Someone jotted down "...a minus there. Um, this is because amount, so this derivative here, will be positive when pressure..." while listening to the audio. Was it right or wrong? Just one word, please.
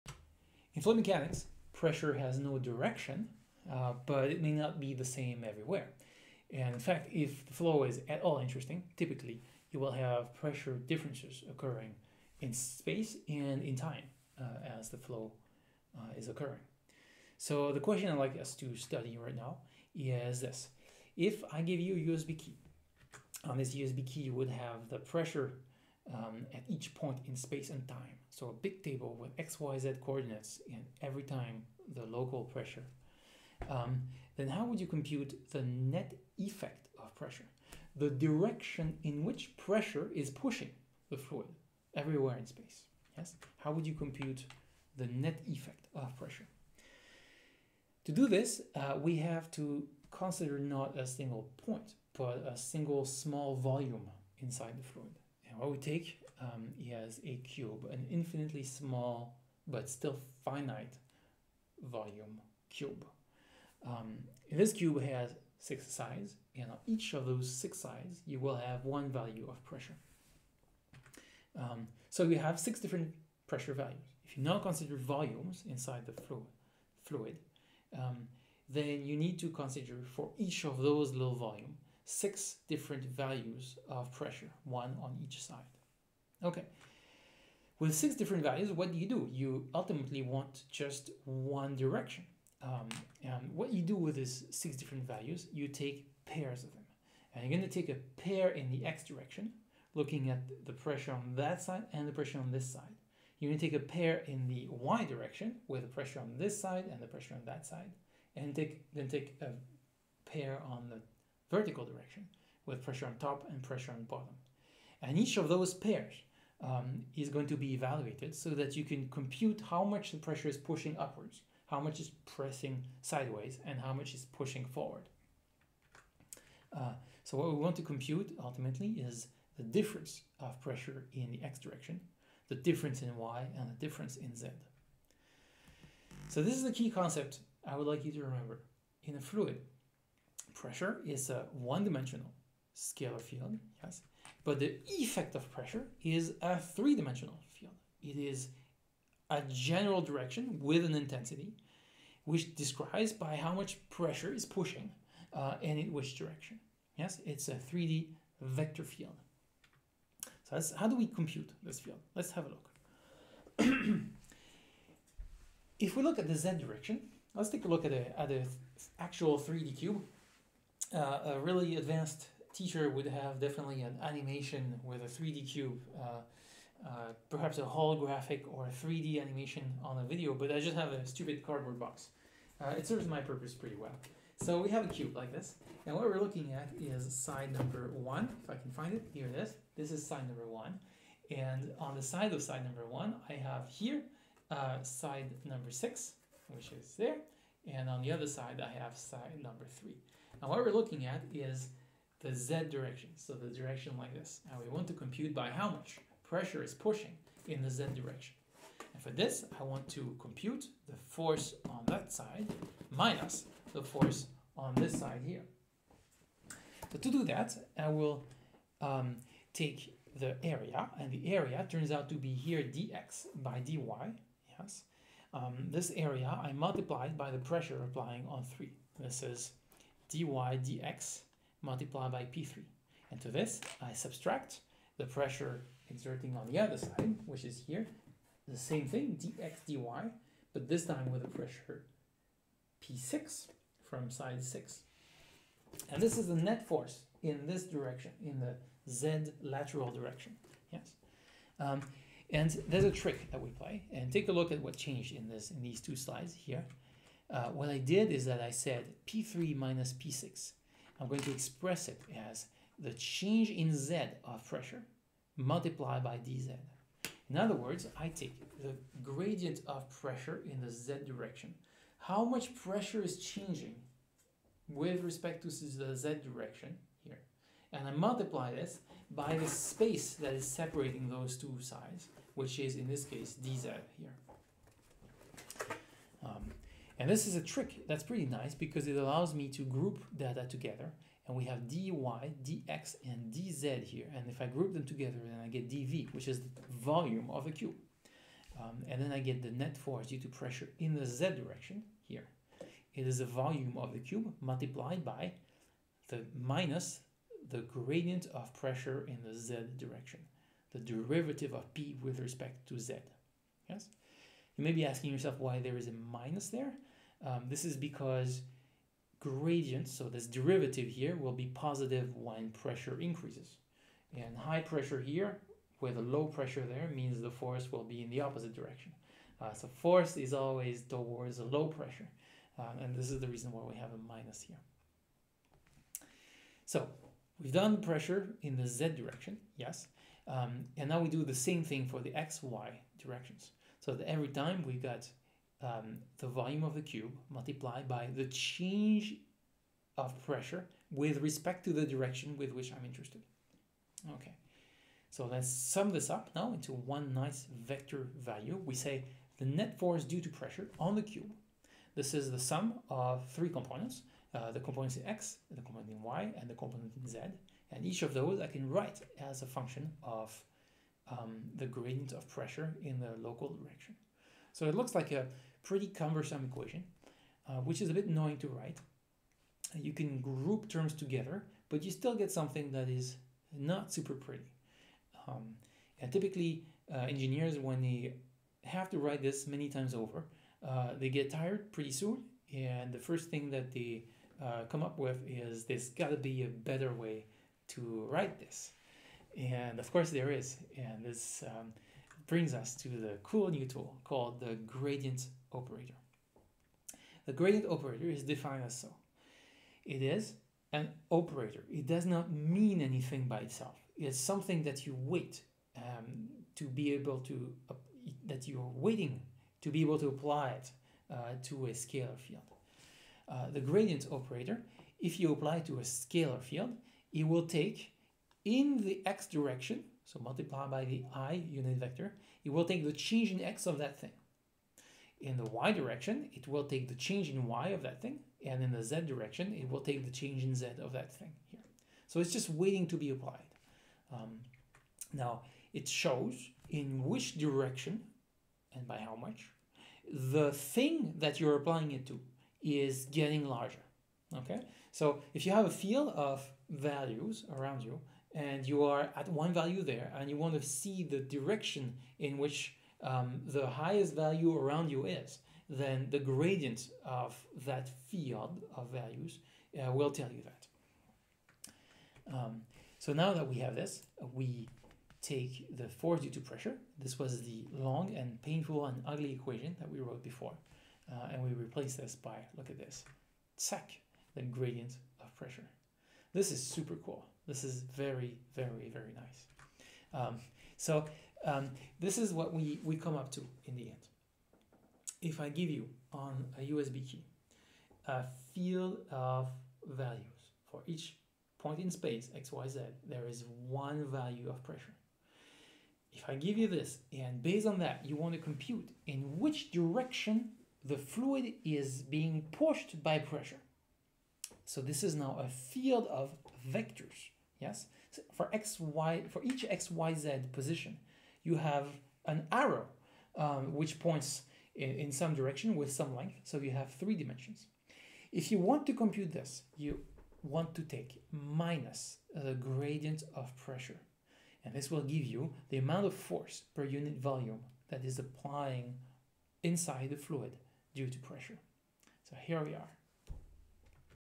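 wrong.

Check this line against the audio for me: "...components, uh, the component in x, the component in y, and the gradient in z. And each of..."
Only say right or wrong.
wrong.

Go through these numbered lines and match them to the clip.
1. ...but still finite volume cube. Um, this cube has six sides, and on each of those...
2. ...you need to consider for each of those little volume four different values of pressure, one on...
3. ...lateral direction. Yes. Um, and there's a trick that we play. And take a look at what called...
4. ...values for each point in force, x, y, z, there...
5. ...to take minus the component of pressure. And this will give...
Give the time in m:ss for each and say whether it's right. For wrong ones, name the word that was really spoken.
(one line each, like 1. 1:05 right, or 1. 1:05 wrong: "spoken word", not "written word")
1. 0:59 right
2. 1:19 wrong: "six", not "four"
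3. 4:09 wrong: "changed", not "called"
4. 8:19 wrong: "space", not "force"
5. 8:50 wrong: "gradient", not "component".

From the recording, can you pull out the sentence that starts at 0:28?
So a big table with x, y, z coordinates and every time the local pressure.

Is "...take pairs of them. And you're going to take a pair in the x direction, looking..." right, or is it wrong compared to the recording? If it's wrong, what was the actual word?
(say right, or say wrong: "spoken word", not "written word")
right.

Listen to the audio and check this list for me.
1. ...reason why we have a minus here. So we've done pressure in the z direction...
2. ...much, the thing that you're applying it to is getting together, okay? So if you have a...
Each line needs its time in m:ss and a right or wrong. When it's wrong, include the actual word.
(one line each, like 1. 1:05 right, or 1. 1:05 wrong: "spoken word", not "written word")
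1. 5:33 right
2. 7:29 wrong: "larger", not "together".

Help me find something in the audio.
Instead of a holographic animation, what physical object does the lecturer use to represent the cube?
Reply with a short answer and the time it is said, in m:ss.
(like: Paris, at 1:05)
cardboard box, at 3:01.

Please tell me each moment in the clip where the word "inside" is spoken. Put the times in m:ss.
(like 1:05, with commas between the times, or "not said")
0:54, 1:15, 8:59.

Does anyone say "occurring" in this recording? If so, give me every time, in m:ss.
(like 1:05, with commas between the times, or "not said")
0:11, 0:16.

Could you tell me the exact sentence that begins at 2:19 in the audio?
In a fluid, pressure is a one-dimensional scalar field, yes, but the effect of pressure is a three-dimensional field.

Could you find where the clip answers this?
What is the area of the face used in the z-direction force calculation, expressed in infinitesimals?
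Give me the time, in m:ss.
3:42.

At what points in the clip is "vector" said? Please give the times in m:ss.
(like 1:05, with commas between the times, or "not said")
2:38, 5:57, 7:11, 8:36.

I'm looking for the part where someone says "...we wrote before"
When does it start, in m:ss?
7:59.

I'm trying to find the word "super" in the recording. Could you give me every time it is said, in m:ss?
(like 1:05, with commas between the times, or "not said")
6:23, 8:06.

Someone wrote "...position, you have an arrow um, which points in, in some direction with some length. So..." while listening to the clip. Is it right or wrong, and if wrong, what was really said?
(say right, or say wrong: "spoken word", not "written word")
right.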